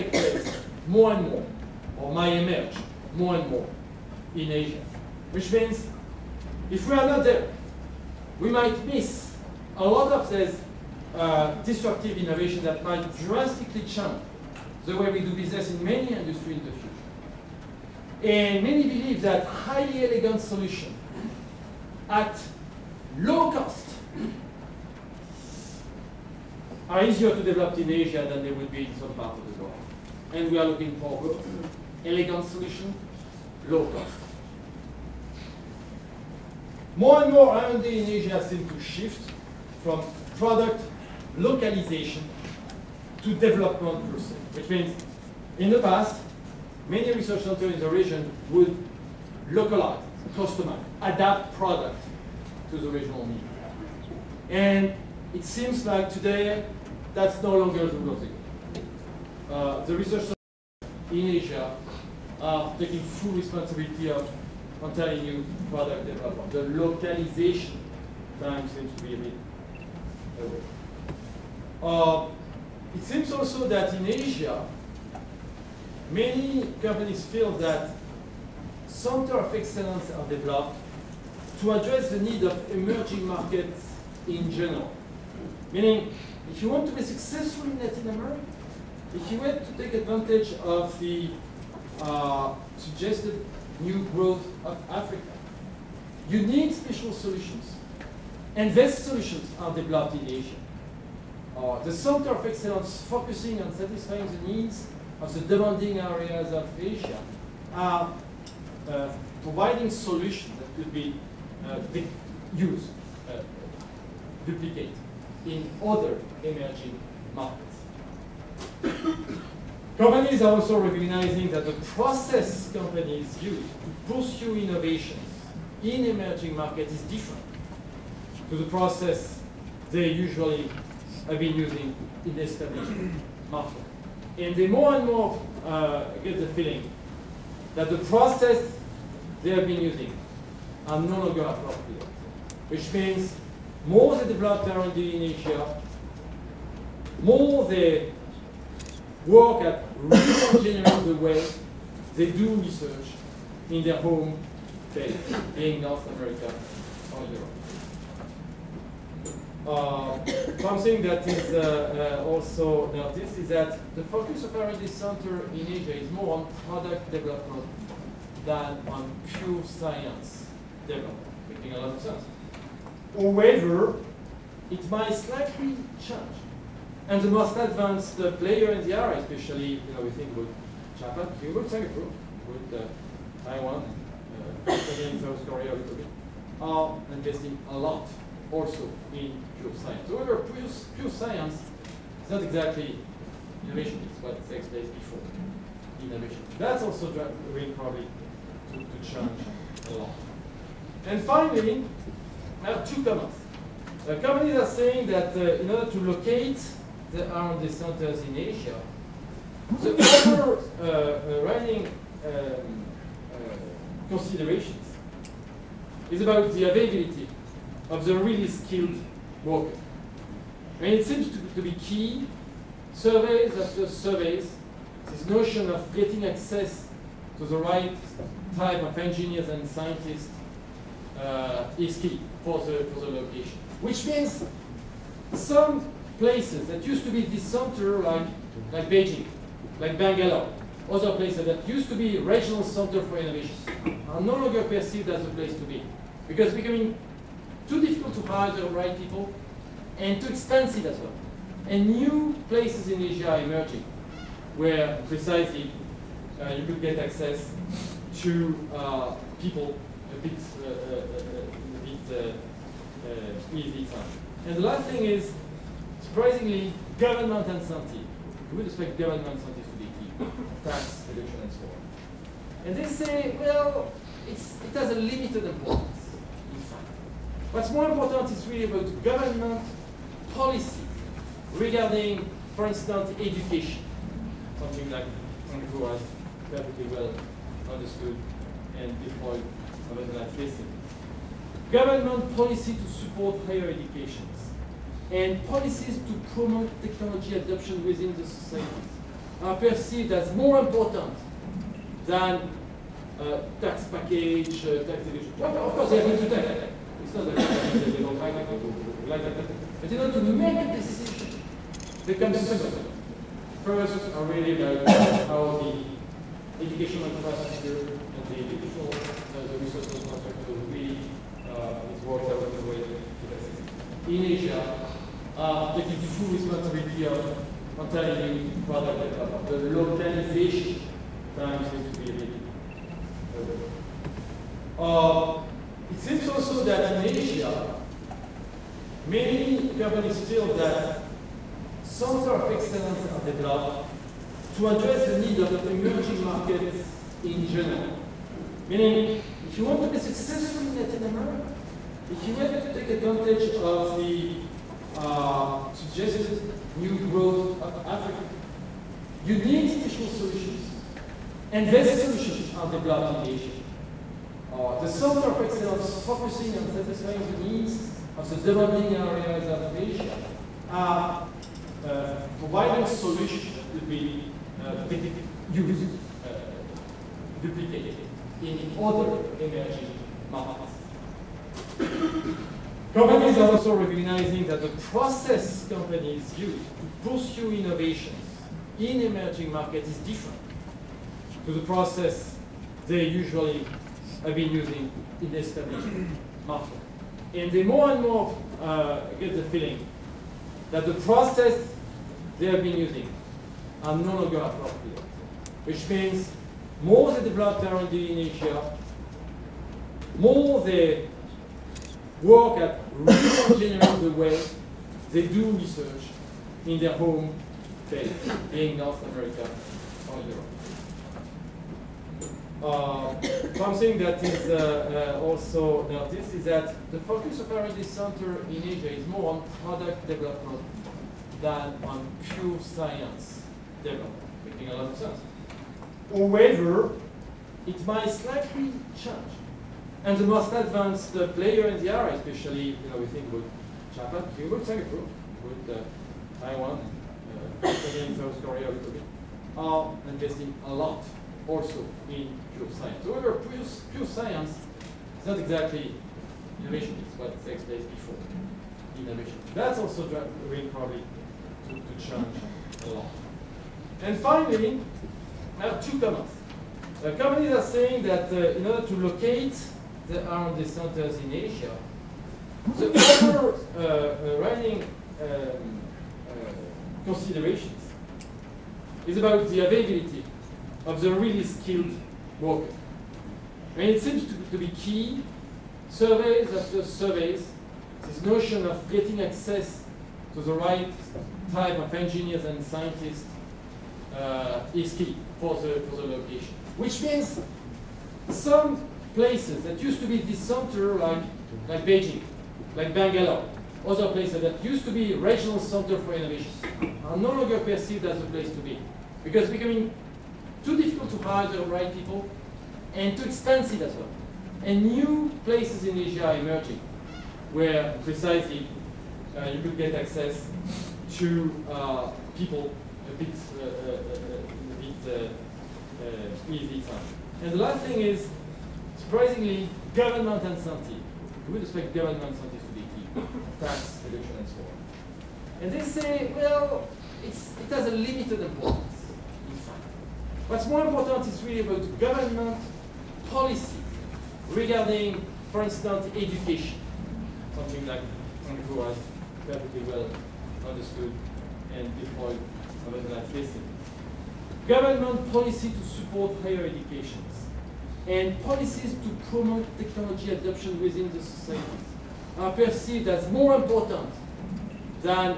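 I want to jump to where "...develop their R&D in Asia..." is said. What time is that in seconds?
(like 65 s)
407 s.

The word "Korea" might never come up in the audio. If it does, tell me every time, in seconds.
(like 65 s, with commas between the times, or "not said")
185 s, 448 s.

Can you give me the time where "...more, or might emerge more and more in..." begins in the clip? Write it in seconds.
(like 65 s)
1 s.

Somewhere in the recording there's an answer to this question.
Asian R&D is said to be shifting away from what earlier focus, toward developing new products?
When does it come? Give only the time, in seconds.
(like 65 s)
40 s.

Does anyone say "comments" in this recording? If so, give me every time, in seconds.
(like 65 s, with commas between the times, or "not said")
203 s, 465 s.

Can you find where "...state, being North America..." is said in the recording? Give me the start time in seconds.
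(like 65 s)
154 s.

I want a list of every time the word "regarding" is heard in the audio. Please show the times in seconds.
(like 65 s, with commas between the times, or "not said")
281 s, 544 s.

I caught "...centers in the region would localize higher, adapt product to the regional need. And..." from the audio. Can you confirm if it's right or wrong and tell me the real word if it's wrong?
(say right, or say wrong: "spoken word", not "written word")
wrong: "customer", not "higher".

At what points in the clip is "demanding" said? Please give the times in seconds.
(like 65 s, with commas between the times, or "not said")
105 s, 368 s.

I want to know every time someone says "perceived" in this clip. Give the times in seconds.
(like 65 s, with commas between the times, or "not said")
244 s, 299 s, 507 s, 562 s.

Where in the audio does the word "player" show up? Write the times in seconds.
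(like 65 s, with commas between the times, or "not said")
178 s, 441 s.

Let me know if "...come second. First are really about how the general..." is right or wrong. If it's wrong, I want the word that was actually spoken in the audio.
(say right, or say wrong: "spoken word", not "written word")
wrong: "educational", not "general".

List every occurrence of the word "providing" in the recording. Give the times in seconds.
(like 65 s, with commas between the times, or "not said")
109 s, 372 s.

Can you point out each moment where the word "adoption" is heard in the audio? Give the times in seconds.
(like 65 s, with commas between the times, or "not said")
297 s, 560 s.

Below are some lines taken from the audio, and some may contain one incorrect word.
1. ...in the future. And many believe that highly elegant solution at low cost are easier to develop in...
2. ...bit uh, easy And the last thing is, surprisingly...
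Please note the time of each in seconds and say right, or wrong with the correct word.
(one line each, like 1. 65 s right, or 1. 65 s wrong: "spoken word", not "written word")
1. 16 s right
2. 524 s right.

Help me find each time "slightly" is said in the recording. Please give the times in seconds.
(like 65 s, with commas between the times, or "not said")
175 s, 438 s.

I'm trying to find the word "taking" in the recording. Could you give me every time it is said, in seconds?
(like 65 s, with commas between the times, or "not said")
62 s, 325 s.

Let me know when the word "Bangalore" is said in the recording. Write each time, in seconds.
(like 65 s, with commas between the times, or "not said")
239 s, 502 s.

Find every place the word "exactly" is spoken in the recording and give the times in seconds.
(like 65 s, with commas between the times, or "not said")
192 s, 455 s.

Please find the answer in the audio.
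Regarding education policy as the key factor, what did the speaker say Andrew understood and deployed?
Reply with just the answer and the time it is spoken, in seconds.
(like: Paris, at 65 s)
standardized testing, at 289 s.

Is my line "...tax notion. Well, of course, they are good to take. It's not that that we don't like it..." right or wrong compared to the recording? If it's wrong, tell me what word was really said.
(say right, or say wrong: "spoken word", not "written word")
wrong: "division", not "notion".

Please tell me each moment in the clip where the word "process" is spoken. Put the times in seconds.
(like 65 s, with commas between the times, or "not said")
44 s, 121 s, 128 s, 137 s, 384 s, 391 s, 400 s.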